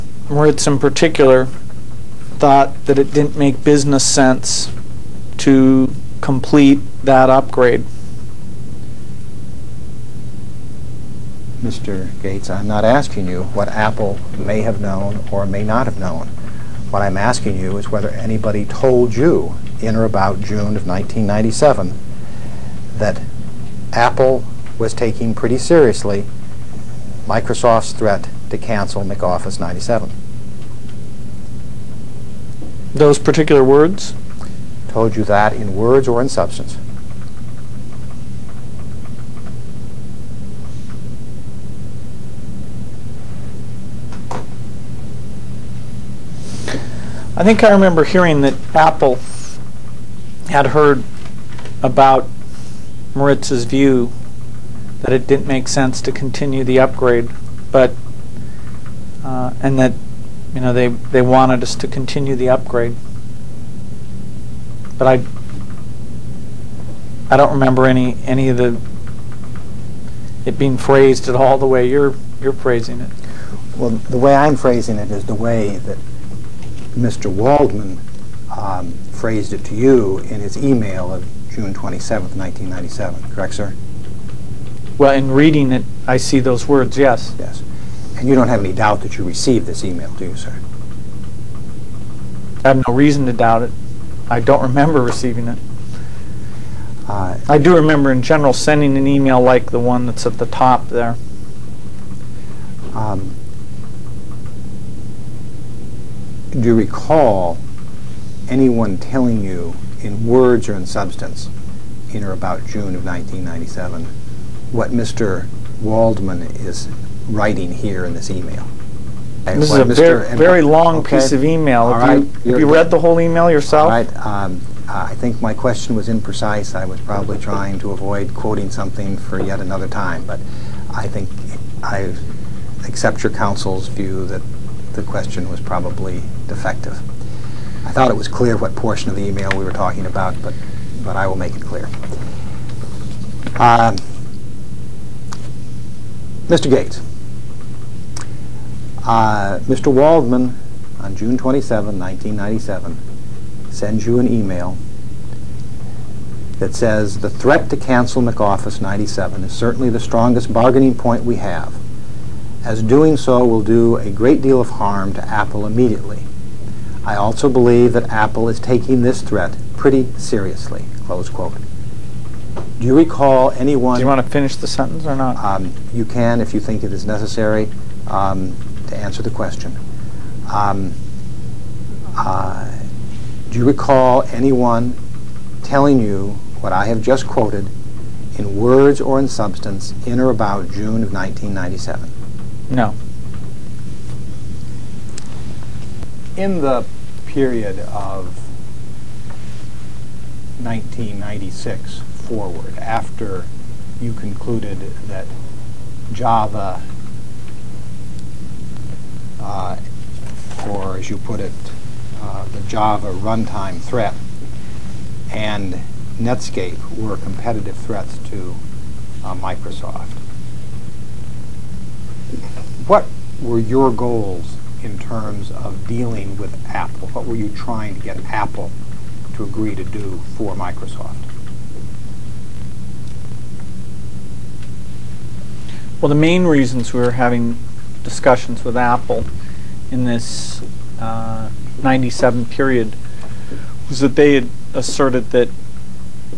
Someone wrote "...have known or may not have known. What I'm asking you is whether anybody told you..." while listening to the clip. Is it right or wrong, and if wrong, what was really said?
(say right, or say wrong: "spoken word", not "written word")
right.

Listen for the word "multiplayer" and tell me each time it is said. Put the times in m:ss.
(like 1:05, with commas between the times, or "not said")
not said.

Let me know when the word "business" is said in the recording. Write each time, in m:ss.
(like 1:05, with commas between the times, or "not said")
0:03.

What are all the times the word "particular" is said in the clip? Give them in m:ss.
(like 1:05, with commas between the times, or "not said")
0:00, 0:33.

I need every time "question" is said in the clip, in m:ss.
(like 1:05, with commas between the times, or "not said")
2:05, 2:15, 2:59.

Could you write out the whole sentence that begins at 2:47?
I also believe that Apple is taking this threat pretty seriously, close quote.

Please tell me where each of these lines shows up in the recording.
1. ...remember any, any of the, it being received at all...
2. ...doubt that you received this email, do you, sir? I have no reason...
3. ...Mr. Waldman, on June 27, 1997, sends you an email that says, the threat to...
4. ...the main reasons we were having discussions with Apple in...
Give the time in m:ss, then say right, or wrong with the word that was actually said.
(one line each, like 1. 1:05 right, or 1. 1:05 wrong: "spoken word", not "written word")
1. 1:07 wrong: "phrased", not "received"
2. 1:28 right
3. 2:29 right
4. 3:56 right.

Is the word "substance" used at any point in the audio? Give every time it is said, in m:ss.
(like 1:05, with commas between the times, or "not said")
0:36, 1:50, 3:09.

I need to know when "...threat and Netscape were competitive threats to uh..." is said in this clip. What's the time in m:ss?
3:33.